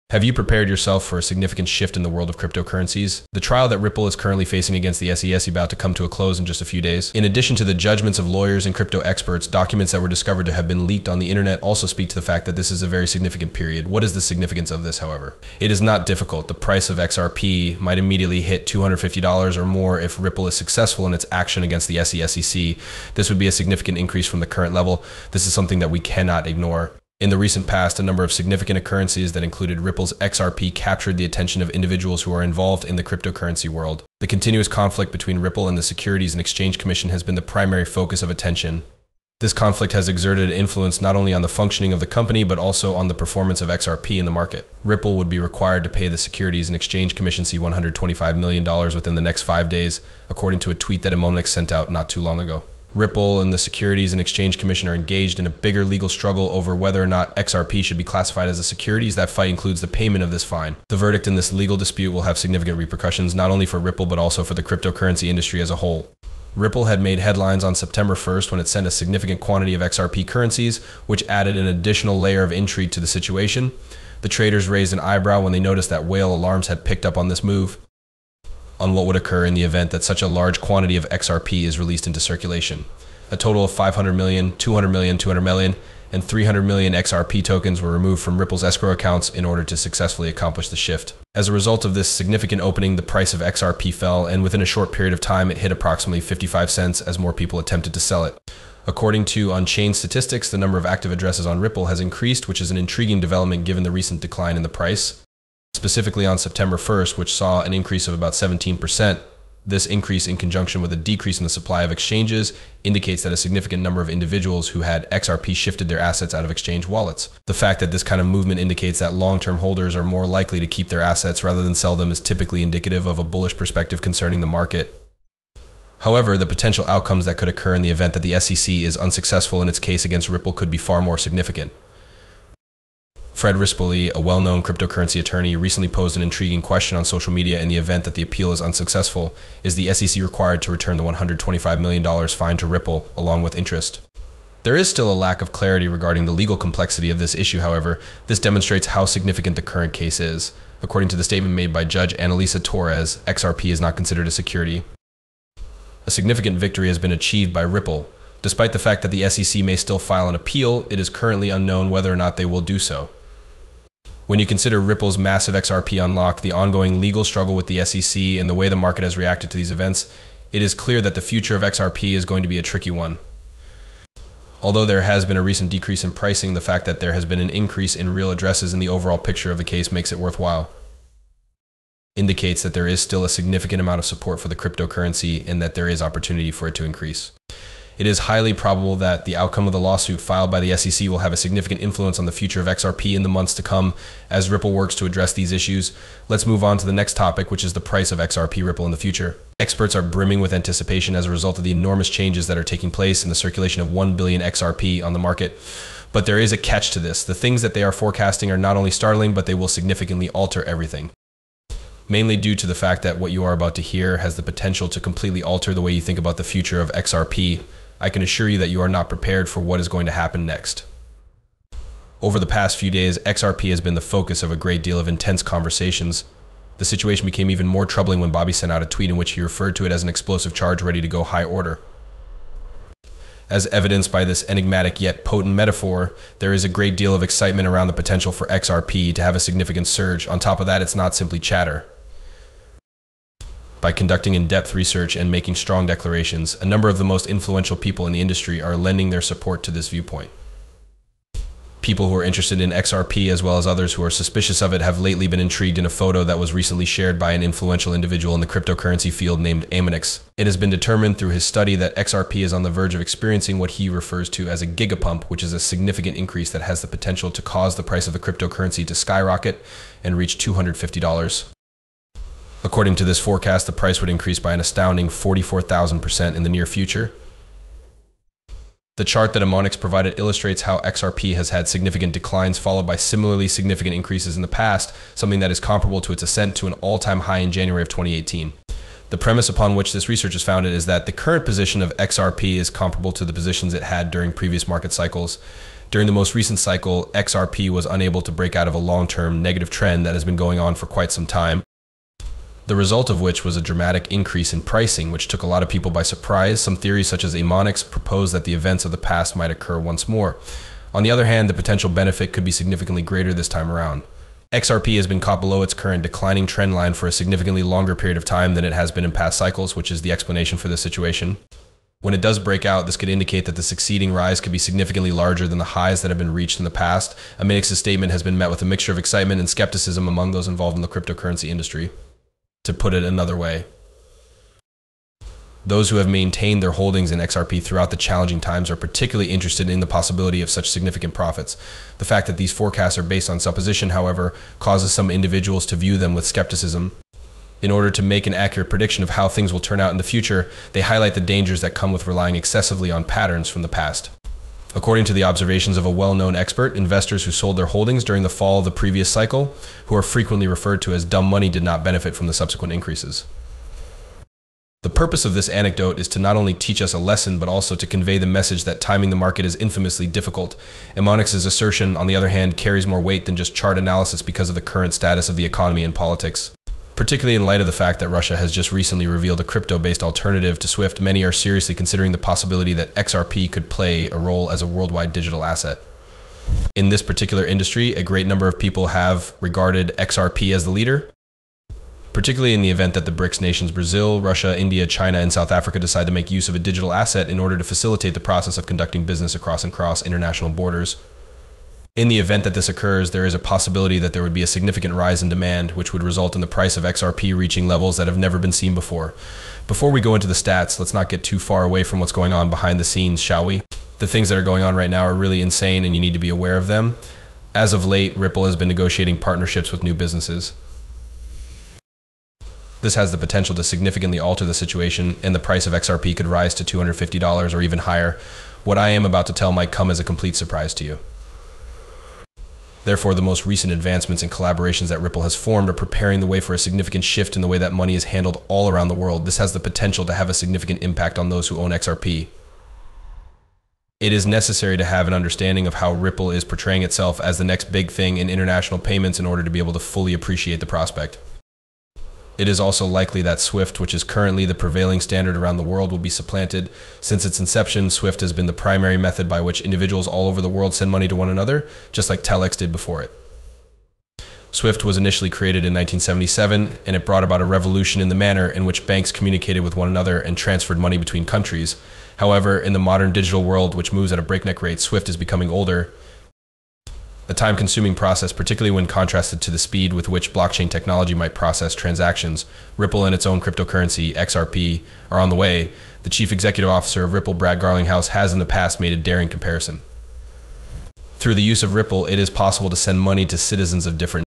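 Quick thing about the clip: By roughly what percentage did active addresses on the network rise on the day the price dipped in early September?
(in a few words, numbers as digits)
17%.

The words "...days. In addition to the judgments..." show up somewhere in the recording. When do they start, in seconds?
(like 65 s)
6 s.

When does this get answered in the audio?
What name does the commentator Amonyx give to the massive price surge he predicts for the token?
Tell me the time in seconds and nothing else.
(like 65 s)
264 s.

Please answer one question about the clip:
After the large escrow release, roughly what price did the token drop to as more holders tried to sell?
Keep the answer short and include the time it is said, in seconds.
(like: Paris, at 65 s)
55 cents, at 96 s.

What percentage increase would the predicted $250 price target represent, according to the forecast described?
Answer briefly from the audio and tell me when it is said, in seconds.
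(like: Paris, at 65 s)
44,000%, at 275 s.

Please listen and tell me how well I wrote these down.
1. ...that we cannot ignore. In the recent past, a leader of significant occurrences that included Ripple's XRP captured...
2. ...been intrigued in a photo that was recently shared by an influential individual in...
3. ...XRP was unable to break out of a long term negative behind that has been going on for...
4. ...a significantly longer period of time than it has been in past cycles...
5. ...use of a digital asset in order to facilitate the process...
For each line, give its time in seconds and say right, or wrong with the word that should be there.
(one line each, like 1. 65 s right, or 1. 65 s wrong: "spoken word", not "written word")
1. 25 s wrong: "number", not "leader"
2. 255 s right
3. 297 s wrong: "trend", not "behind"
4. 317 s right
5. 396 s right.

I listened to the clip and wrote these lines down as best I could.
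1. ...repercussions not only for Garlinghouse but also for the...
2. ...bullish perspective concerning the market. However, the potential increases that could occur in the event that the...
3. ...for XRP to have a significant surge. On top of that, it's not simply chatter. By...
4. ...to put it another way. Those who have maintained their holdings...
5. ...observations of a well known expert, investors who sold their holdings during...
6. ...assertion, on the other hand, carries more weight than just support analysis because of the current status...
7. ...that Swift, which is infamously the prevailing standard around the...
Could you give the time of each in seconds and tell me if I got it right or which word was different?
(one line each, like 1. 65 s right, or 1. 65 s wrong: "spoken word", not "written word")
1. 62 s wrong: "Ripple", not "Garlinghouse"
2. 123 s wrong: "outcomes", not "increases"
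3. 238 s right
4. 332 s right
5. 355 s right
6. 371 s wrong: "chart", not "support"
7. 453 s wrong: "currently", not "infamously".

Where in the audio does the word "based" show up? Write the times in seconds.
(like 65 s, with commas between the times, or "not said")
343 s, 379 s.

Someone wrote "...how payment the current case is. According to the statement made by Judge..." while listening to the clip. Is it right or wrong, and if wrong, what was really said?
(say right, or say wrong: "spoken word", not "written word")
wrong: "significant", not "payment".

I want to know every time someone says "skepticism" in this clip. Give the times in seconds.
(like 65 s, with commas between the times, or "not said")
329 s, 346 s.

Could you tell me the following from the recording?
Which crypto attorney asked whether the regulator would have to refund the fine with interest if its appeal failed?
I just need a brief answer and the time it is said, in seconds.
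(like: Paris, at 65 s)
Fred Rispoli, at 133 s.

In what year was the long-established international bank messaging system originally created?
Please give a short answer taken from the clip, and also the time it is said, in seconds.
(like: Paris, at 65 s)
1977, at 465 s.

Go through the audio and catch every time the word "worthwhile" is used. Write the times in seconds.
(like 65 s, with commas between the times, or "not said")
180 s.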